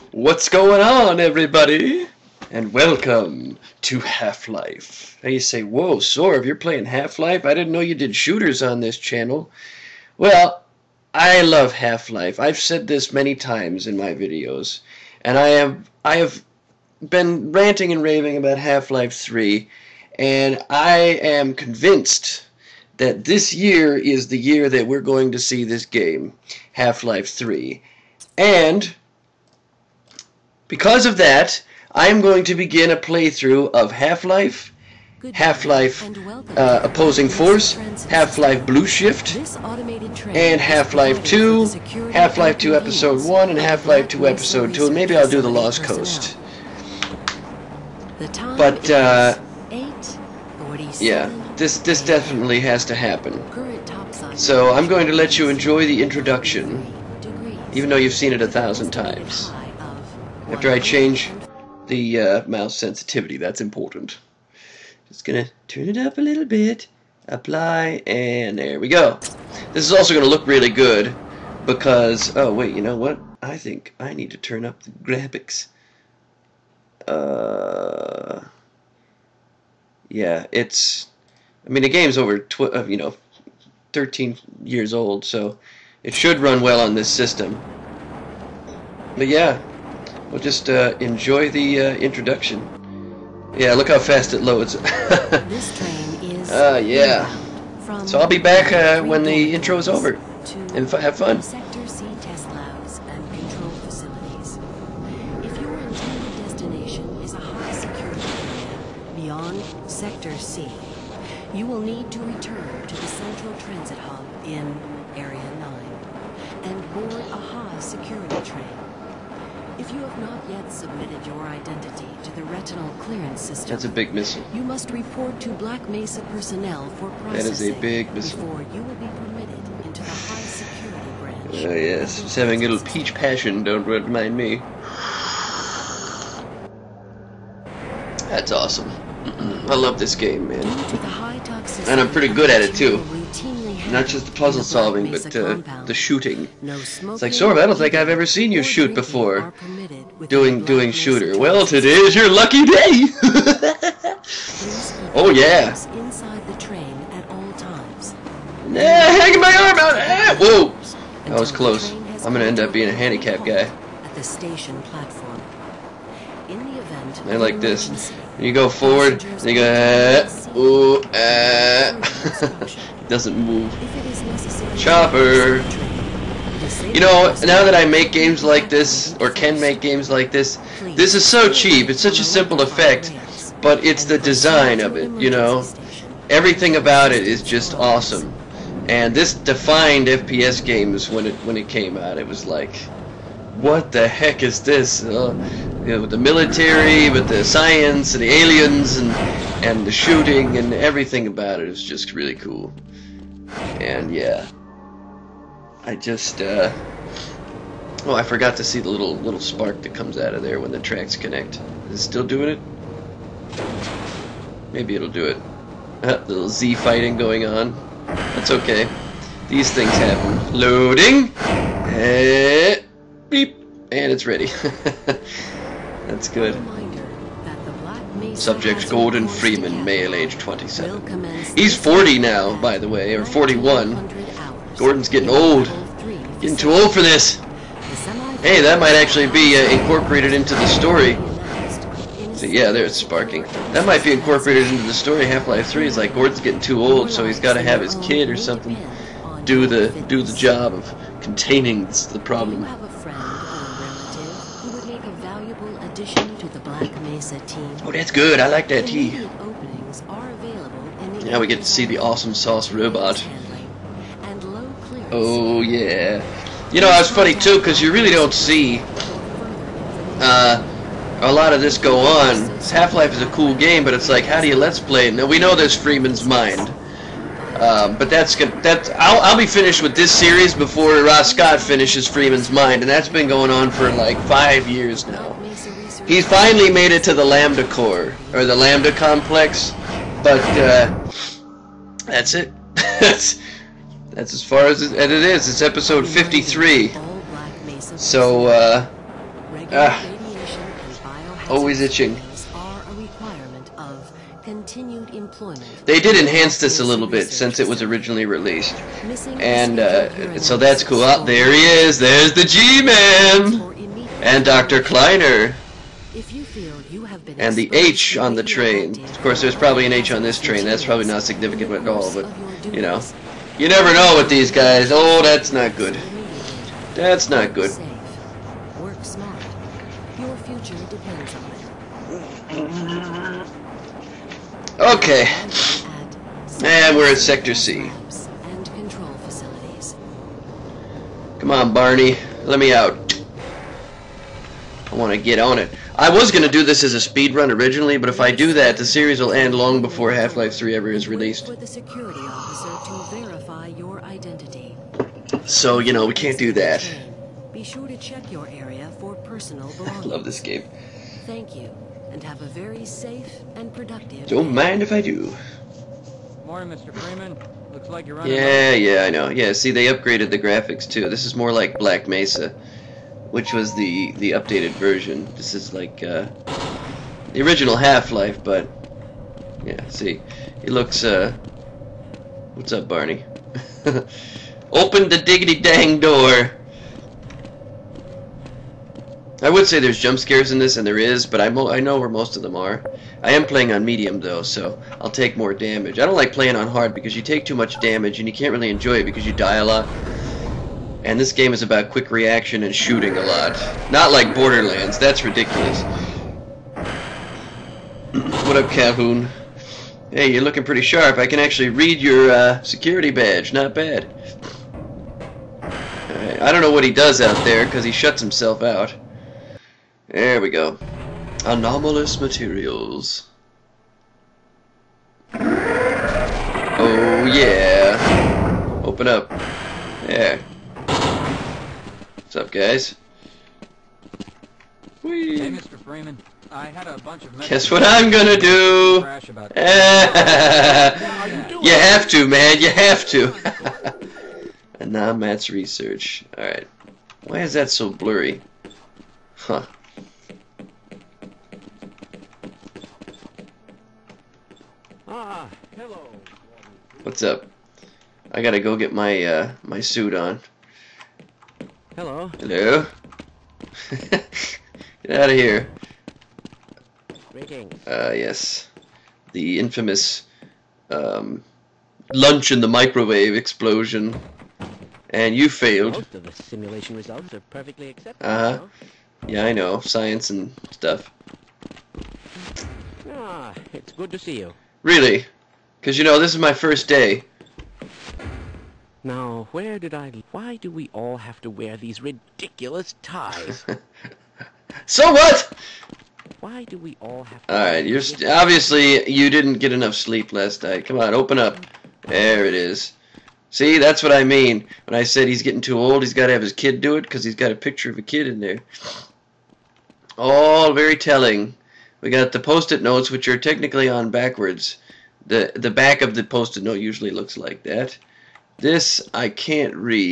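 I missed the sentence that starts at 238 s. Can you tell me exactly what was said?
Hey, that might actually be uh, incorporated into the story.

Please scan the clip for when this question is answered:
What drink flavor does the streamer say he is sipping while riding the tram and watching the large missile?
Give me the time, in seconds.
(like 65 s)
132 s.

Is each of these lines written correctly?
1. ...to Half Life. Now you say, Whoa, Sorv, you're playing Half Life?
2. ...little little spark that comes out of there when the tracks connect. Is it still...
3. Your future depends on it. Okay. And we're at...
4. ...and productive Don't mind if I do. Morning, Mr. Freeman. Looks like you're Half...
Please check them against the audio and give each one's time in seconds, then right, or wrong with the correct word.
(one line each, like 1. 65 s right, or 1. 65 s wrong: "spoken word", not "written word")
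1. 3 s right
2. 208 s right
3. 330 s right
4. 363 s wrong: "Yeah", not "Half".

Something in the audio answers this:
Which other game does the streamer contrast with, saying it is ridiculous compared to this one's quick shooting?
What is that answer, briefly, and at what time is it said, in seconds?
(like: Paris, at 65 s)
Borderlands, at 404 s.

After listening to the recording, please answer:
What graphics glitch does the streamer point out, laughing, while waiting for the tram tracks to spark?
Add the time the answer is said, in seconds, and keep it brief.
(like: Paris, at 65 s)
Z fighting, at 216 s.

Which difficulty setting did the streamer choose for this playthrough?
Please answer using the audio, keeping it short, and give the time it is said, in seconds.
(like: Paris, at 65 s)
Medium, at 393 s.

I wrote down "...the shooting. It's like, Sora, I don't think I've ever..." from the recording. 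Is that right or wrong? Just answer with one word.
right.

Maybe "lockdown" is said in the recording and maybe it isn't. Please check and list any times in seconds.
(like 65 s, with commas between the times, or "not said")
not said.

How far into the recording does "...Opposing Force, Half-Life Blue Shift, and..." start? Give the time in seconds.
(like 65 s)
36 s.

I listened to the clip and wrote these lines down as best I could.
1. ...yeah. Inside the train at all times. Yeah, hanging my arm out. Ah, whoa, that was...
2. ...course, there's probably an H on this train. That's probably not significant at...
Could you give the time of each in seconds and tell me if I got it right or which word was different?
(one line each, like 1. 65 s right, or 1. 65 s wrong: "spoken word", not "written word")
1. 155 s right
2. 319 s right.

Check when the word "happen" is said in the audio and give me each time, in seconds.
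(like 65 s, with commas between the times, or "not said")
52 s, 219 s.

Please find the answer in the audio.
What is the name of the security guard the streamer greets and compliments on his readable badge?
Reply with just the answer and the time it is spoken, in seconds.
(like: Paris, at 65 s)
Calhoun, at 408 s.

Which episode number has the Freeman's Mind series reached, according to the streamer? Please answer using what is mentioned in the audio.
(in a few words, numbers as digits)
53.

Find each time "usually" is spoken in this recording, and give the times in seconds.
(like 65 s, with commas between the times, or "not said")
516 s.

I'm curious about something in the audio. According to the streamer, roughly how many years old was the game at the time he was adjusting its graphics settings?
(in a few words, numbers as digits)
13.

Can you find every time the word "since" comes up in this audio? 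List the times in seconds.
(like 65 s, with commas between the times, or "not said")
307 s.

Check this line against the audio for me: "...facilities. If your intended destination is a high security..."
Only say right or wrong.
right.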